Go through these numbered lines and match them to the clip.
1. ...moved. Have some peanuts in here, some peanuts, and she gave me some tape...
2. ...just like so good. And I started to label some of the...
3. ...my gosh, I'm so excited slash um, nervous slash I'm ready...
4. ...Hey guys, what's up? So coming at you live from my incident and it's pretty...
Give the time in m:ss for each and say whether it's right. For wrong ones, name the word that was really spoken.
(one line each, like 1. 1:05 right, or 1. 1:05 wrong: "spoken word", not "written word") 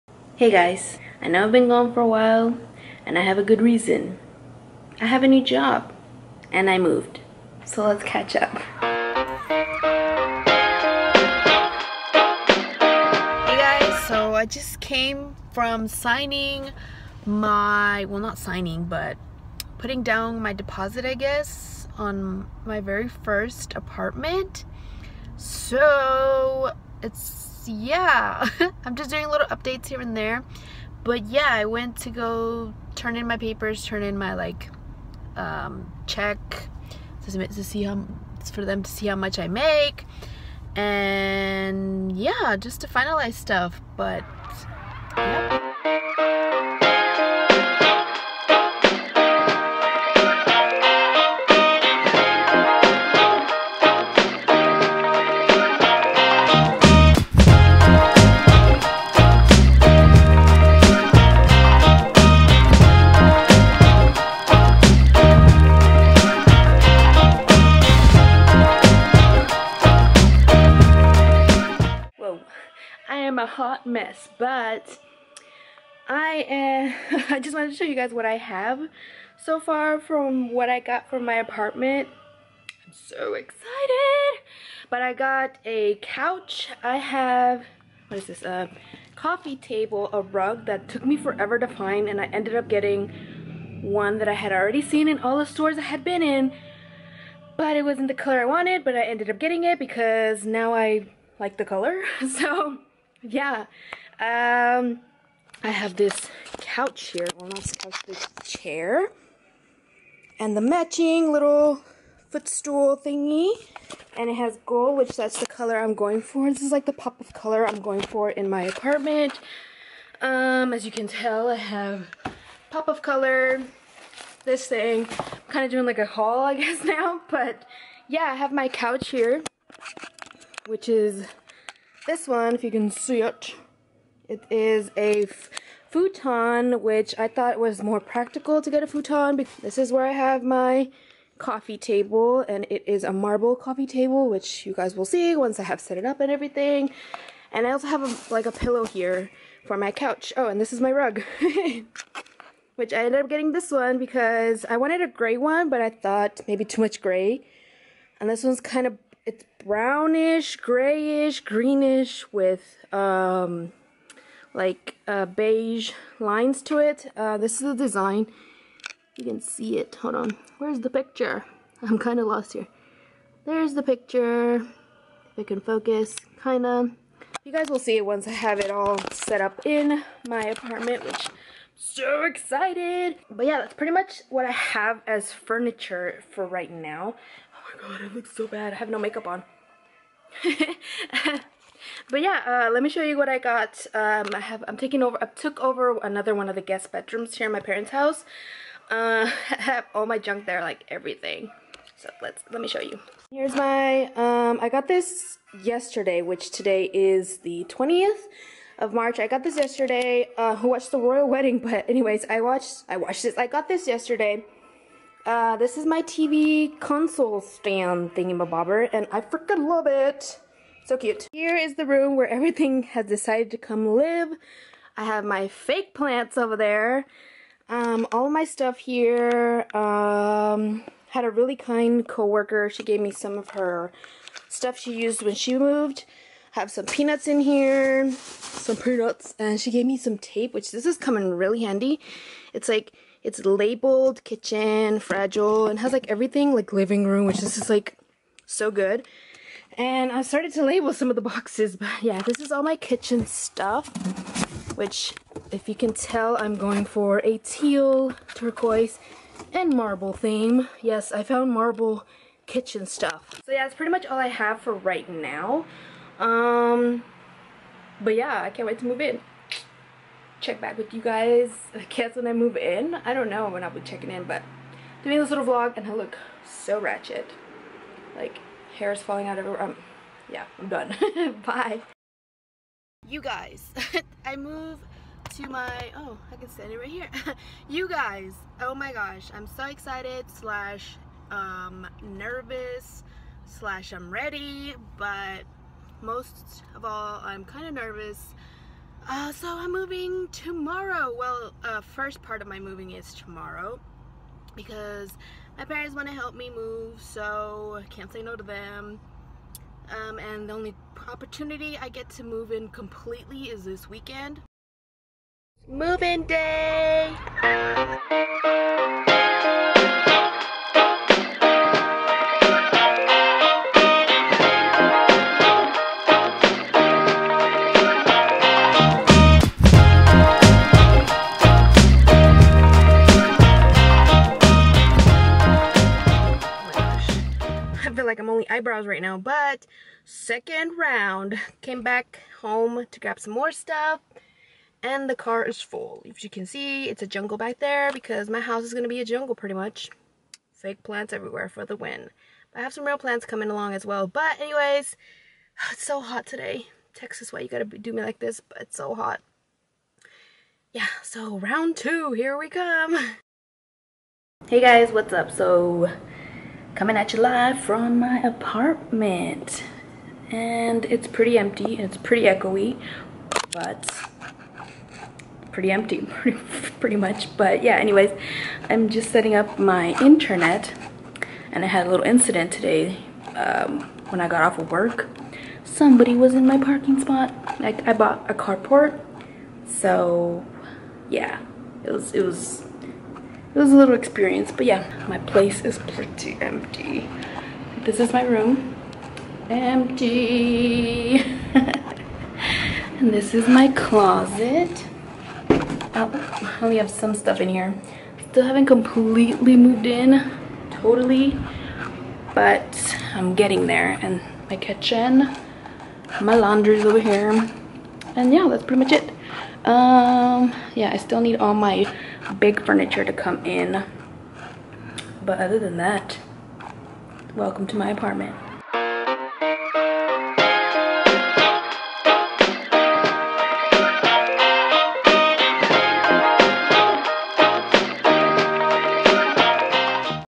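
1. 3:55 right
2. 4:07 right
3. 4:48 right
4. 6:04 wrong: "apartment", not "incident".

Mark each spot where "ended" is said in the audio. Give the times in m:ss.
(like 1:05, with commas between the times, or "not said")
1:32, 1:39, 2:33.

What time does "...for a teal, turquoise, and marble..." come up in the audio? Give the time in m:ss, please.
4:16.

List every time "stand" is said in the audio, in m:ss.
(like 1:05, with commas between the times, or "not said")
3:37, 4:46.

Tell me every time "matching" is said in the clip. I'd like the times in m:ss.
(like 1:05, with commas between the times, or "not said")
1:50.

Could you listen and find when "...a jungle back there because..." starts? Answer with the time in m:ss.
5:47.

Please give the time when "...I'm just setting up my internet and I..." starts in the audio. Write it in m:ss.
6:18.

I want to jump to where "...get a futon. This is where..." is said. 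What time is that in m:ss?
2:18.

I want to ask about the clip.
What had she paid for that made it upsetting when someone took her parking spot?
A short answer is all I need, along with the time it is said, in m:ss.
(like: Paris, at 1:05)
a carport, at 6:28.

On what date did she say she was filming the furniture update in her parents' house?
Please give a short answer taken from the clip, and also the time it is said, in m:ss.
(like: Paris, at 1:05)
20th of March, at 3:27.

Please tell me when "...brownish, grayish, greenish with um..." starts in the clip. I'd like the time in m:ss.
2:39.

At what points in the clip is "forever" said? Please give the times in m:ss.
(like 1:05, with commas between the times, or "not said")
1:31.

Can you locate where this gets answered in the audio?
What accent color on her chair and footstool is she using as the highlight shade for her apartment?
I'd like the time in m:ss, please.
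1:54.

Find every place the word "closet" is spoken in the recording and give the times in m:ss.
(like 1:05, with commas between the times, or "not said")
6:43.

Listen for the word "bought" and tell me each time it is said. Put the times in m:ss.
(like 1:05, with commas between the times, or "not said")
6:27.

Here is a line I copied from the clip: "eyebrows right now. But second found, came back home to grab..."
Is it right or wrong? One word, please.
wrong.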